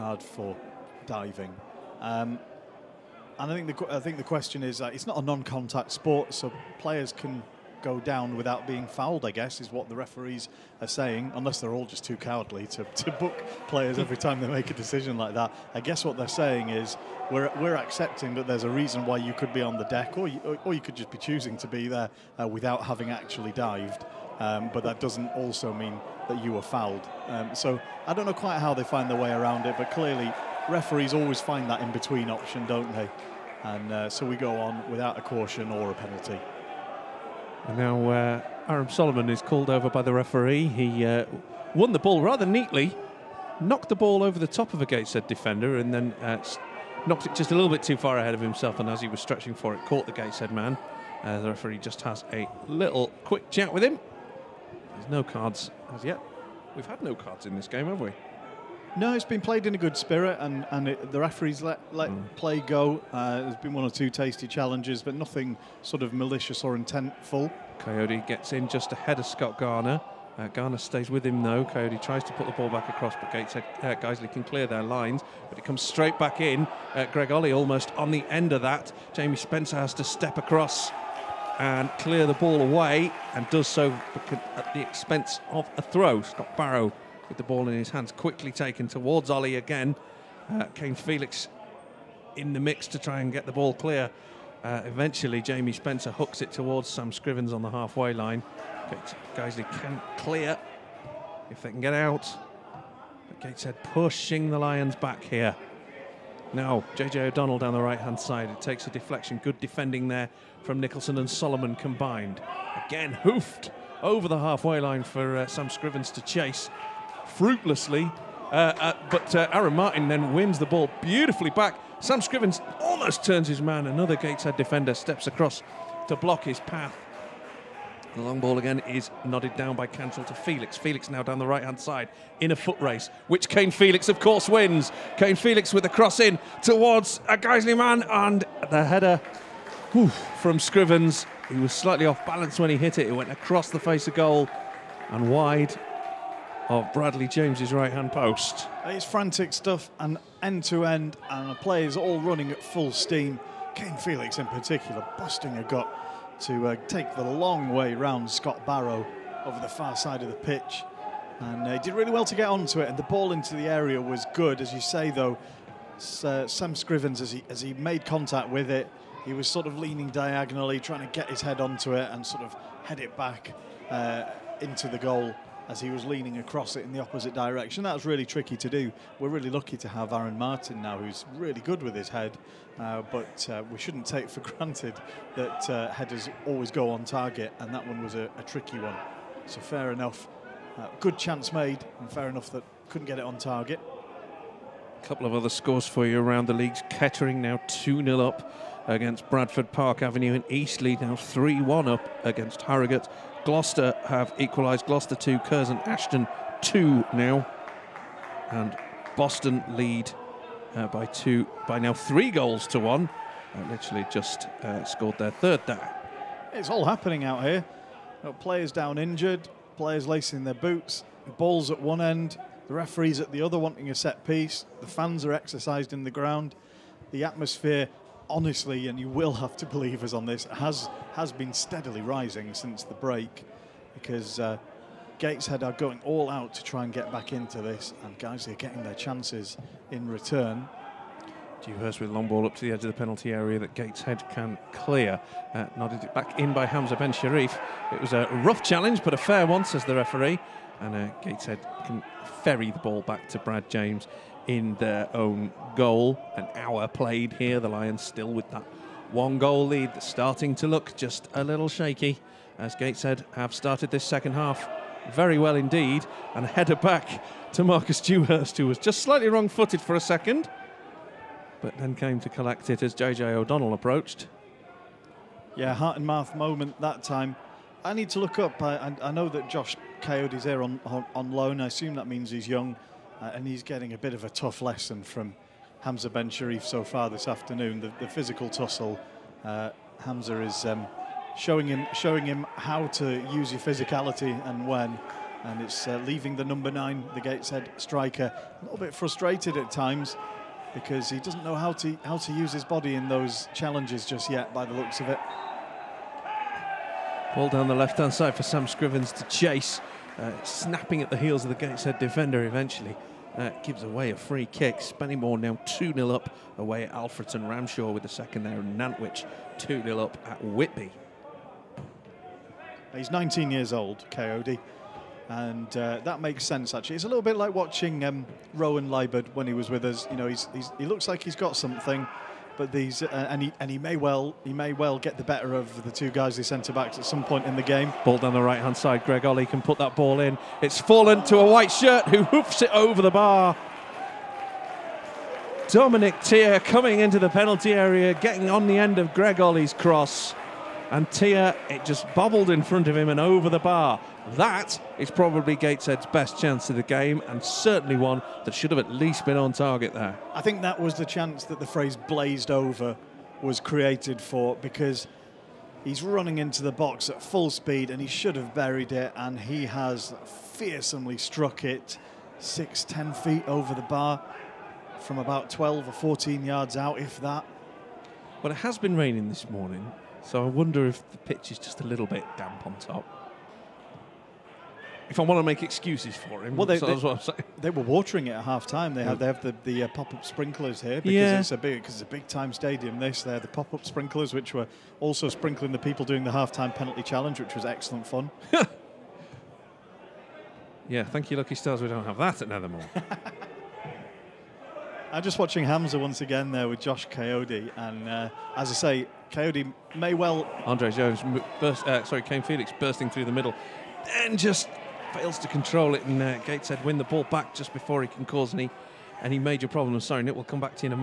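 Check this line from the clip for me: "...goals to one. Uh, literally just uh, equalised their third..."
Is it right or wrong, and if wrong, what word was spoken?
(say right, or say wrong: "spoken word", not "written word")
wrong: "scored", not "equalised".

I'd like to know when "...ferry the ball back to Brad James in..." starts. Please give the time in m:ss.
4:12.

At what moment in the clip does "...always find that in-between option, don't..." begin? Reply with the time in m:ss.
0:31.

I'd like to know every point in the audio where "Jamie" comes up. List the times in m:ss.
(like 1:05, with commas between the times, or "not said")
1:19, 1:35.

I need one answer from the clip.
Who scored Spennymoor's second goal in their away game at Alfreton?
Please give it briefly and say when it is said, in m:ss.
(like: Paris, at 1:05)
Ramshaw, at 5:17.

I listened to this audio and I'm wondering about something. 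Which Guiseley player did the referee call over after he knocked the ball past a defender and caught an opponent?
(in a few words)
Aram Soleman.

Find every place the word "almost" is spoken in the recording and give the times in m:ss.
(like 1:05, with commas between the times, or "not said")
1:17, 2:02.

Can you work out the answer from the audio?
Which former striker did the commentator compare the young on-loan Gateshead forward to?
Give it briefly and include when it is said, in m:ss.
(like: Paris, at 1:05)
Rowan Liburd, at 5:28.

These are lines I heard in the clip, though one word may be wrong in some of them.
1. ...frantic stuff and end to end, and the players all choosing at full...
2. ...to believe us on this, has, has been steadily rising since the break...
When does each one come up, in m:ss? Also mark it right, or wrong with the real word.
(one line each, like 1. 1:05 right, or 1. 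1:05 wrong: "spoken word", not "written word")
1. 2:29 wrong: "running", not "choosing"
2. 3:49 right.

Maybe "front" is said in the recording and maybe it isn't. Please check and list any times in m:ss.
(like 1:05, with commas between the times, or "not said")
5:52.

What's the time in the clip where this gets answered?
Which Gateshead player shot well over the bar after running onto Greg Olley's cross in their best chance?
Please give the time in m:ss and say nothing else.
5:45.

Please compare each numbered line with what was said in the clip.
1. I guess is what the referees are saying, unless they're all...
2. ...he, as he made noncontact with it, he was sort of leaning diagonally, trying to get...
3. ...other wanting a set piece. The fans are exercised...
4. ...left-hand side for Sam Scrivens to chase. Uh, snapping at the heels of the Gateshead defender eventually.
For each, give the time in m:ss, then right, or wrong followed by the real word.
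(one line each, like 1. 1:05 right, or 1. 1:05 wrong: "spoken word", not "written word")
1. 0:09 right
2. 2:47 wrong: "contact", not "noncontact"
3. 3:43 right
4. 5:07 right.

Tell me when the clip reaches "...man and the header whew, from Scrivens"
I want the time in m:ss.
2:17.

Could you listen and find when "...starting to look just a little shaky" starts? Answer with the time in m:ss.
4:20.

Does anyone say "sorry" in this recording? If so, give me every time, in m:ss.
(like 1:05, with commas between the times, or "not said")
6:52, 7:00.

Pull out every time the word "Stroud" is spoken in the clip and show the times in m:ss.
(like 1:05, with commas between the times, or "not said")
not said.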